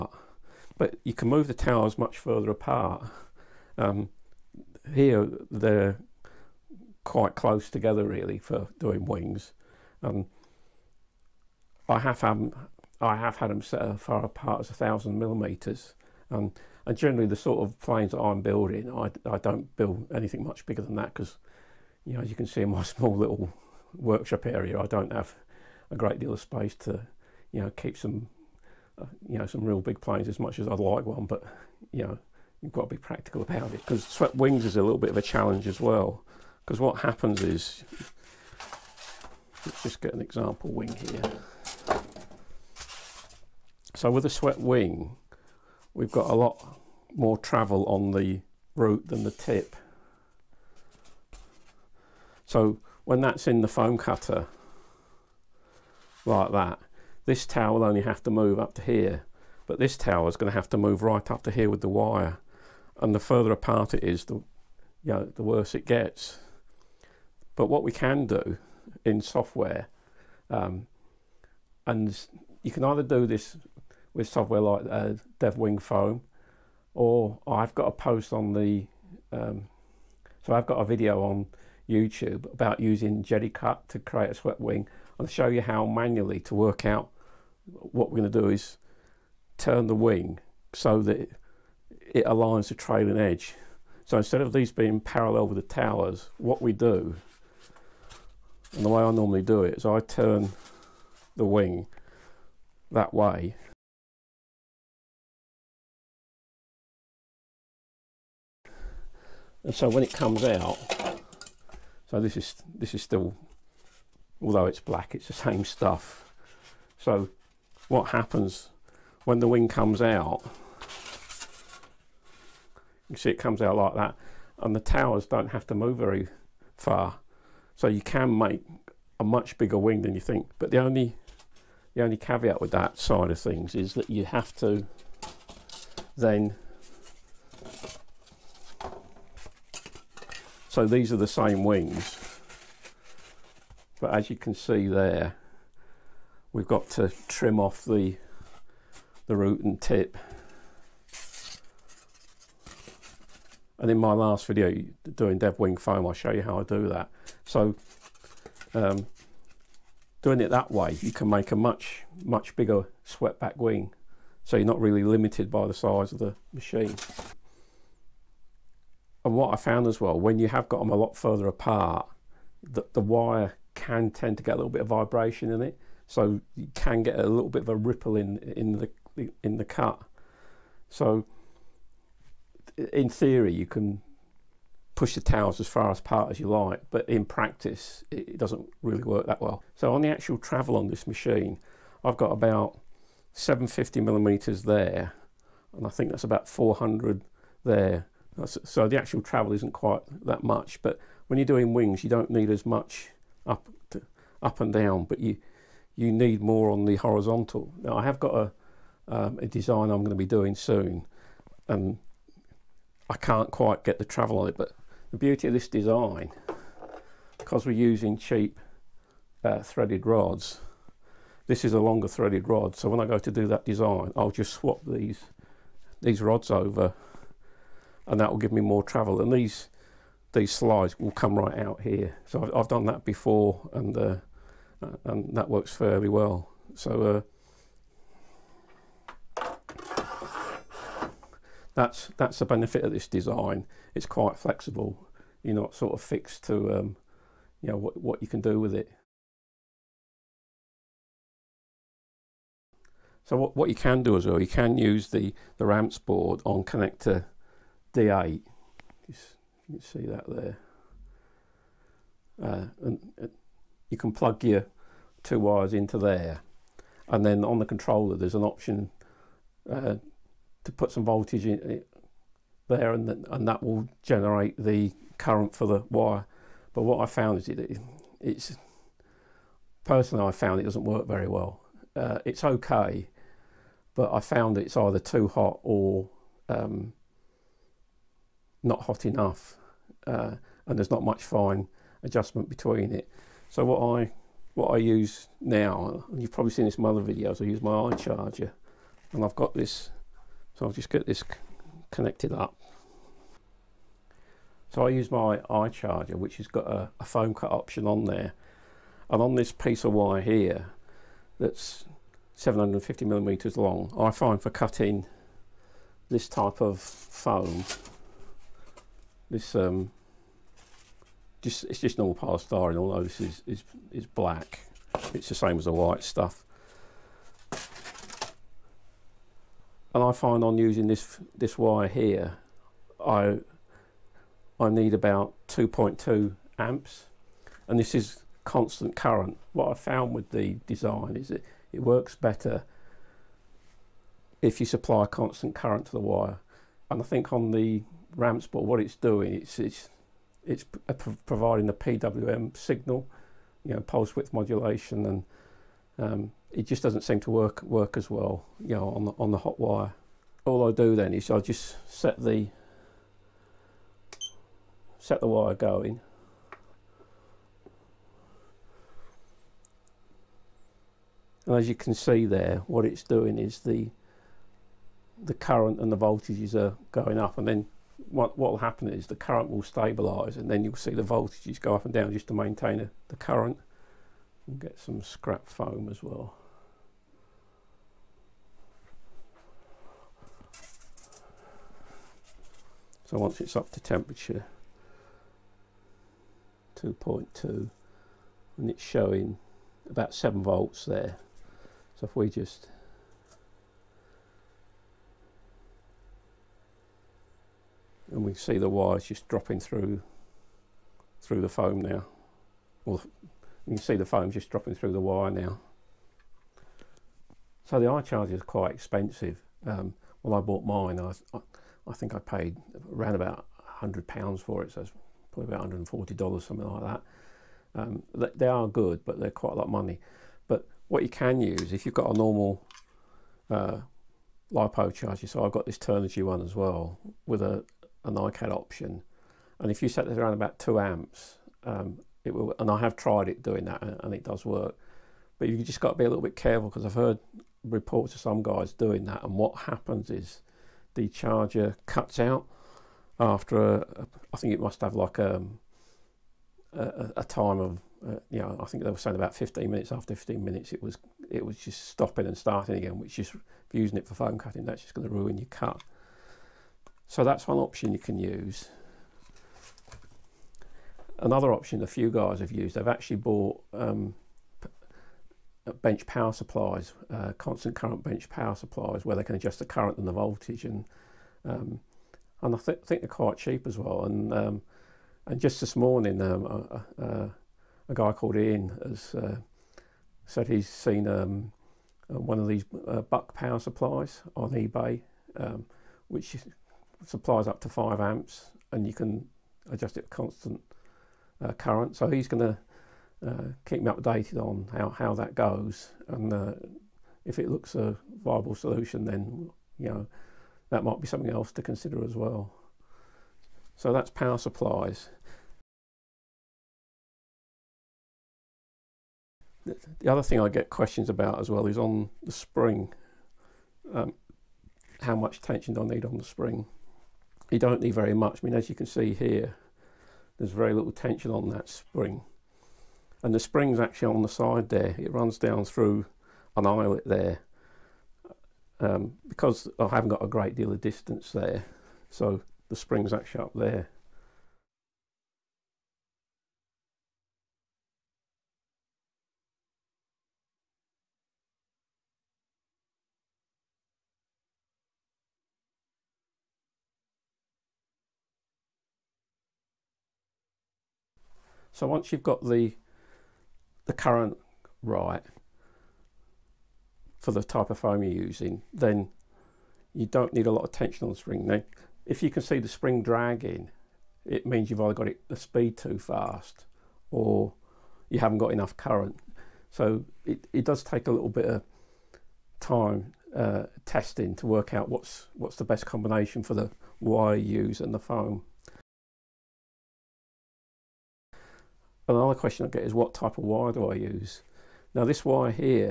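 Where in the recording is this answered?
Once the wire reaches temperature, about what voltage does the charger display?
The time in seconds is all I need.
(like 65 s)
400 s.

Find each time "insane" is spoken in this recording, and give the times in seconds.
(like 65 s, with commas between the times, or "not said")
not said.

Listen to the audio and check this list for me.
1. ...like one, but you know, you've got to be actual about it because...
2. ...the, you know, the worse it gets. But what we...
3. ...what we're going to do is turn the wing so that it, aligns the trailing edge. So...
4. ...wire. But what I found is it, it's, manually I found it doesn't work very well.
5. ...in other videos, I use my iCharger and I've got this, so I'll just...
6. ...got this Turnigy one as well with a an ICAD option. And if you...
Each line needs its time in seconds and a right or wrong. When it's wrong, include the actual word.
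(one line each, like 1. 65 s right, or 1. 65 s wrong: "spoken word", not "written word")
1. 30 s wrong: "practical", not "actual"
2. 64 s right
3. 87 s right
4. 275 s wrong: "personally", not "manually"
5. 296 s right
6. 435 s right.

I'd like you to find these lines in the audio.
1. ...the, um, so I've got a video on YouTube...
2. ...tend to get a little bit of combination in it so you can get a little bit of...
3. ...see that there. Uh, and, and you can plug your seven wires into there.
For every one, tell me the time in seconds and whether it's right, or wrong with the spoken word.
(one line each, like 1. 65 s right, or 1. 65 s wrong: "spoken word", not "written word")
1. 78 s right
2. 174 s wrong: "vibration", not "combination"
3. 259 s wrong: "two", not "seven".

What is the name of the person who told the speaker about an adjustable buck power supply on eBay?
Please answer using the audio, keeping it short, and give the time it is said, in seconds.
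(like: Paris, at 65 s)
Ian, at 488 s.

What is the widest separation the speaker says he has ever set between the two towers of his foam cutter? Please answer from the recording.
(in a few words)
1000 millimeters.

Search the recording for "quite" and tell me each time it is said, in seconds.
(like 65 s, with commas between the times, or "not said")
7 s, 199 s, 213 s, 244 s, 418 s, 429 s, 483 s.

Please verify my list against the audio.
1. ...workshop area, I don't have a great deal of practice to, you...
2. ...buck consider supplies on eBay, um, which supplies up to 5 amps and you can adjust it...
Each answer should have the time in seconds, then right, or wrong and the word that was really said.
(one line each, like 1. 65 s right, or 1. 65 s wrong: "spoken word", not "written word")
1. 23 s wrong: "space", not "practice"
2. 493 s wrong: "power", not "consider".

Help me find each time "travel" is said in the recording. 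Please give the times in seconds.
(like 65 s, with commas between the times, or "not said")
47 s, 190 s, 199 s, 214 s, 228 s.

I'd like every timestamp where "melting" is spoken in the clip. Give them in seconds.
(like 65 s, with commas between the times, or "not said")
not said.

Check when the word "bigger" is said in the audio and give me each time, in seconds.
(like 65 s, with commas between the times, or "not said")
20 s, 129 s, 162 s.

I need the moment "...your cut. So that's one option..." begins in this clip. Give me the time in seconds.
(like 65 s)
465 s.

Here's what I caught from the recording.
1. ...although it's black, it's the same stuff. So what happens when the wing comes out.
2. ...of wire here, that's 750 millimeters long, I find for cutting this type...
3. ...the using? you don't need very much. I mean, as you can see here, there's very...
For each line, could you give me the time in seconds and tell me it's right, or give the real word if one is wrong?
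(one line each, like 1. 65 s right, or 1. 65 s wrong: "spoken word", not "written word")
1. 114 s right
2. 309 s right
3. 526 s wrong: "spring", not "using".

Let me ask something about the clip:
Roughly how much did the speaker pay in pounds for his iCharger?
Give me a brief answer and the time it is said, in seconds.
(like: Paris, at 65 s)
100 pounds, at 423 s.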